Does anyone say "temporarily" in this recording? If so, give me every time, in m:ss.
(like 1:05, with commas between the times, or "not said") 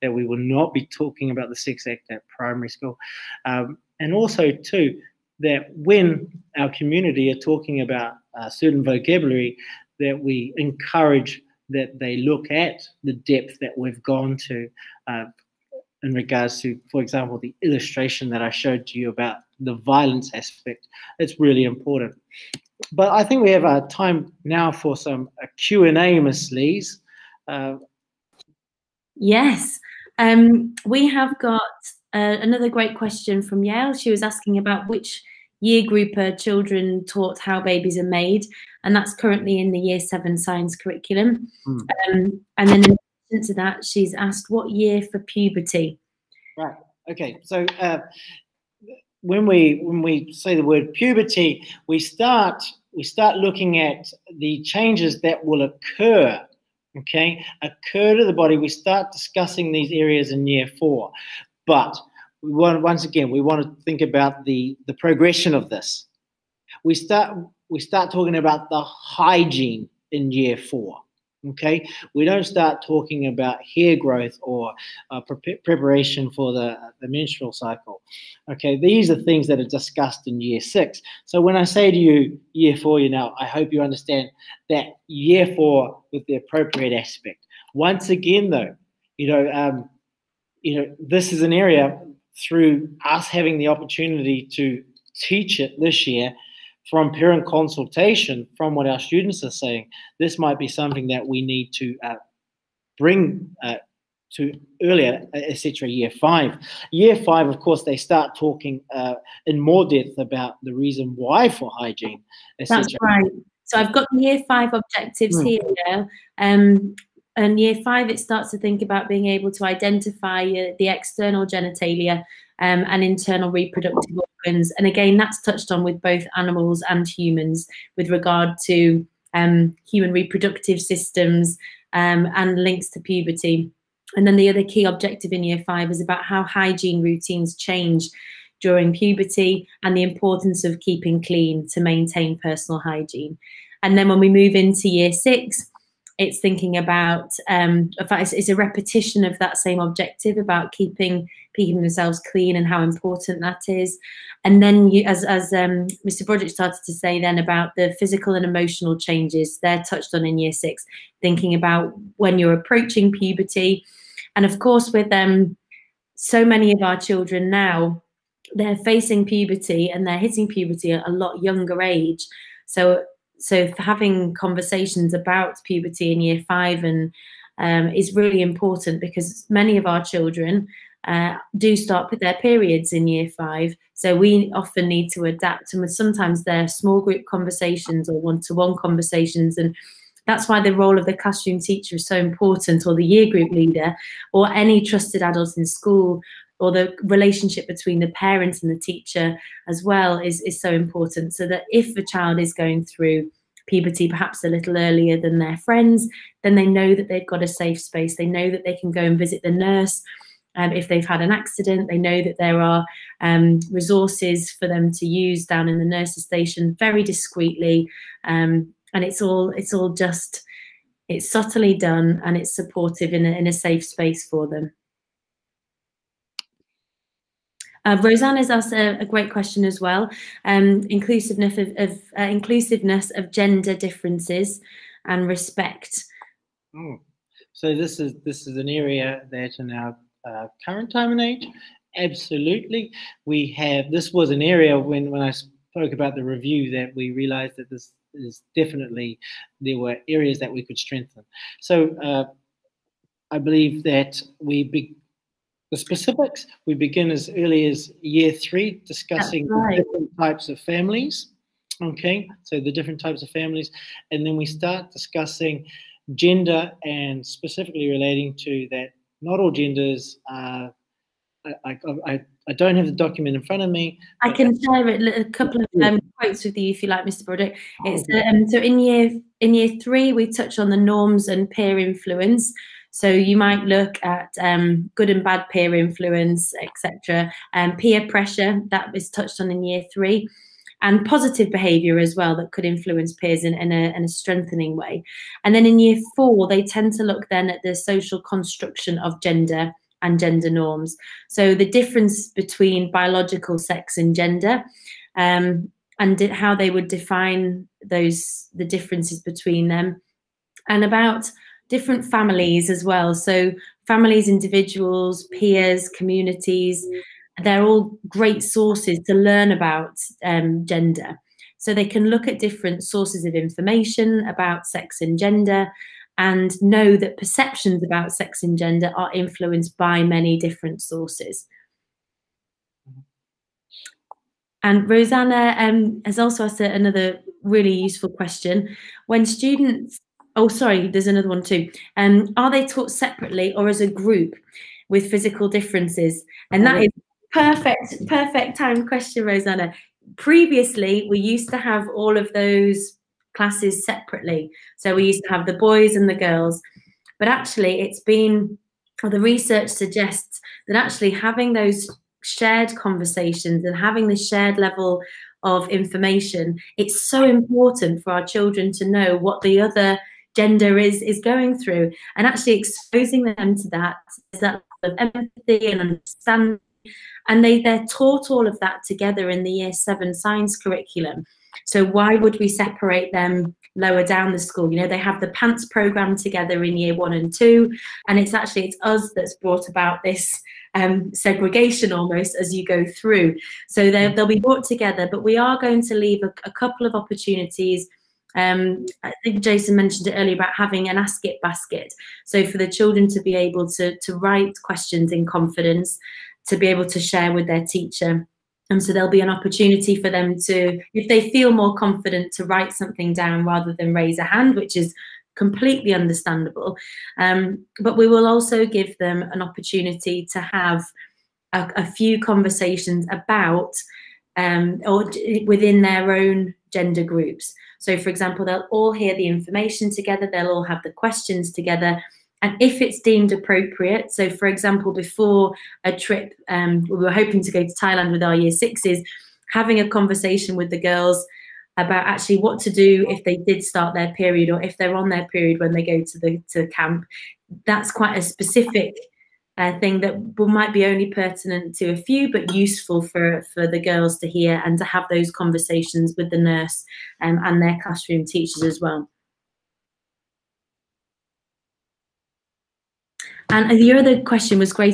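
not said.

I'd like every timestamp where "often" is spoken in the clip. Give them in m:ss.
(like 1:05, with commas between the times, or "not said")
3:04.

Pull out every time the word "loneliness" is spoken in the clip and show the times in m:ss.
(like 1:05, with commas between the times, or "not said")
not said.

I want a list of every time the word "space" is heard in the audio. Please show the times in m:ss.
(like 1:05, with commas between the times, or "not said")
3:27, 3:43.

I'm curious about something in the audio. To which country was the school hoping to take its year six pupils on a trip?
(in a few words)
Thailand.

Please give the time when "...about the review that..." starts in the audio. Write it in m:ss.
4:05.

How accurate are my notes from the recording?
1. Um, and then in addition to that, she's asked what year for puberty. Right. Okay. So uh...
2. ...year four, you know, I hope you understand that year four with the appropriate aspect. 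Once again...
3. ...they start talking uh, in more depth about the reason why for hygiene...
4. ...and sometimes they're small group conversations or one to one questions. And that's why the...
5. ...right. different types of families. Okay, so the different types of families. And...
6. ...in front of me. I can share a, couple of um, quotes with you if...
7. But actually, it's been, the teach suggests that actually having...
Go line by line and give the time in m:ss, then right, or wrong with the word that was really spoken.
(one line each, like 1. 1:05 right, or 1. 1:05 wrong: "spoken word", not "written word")
1. 0:42 right
2. 1:22 right
3. 1:47 right
4. 3:05 wrong: "conversations", not "questions"
5. 4:19 right
6. 4:33 right
7. 5:57 wrong: "research", not "teach".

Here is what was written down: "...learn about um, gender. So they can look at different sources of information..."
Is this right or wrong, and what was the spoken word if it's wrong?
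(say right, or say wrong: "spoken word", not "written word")
right.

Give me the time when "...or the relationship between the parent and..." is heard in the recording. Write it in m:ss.
3:16.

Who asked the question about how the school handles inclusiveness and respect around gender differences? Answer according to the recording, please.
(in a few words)
Roseanne.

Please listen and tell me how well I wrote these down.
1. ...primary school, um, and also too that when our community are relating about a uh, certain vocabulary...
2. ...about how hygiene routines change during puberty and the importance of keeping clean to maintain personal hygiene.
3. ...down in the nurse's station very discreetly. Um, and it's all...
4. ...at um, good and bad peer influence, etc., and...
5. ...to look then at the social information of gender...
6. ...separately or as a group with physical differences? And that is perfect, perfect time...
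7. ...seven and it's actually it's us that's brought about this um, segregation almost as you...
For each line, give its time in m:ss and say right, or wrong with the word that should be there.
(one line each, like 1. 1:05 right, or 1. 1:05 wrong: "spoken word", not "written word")
1. 0:02 wrong: "talking", not "relating"
2. 2:16 right
3. 3:35 right
4. 4:44 right
5. 4:56 wrong: "construction", not "information"
6. 5:42 right
7. 6:27 wrong: "two", not "seven".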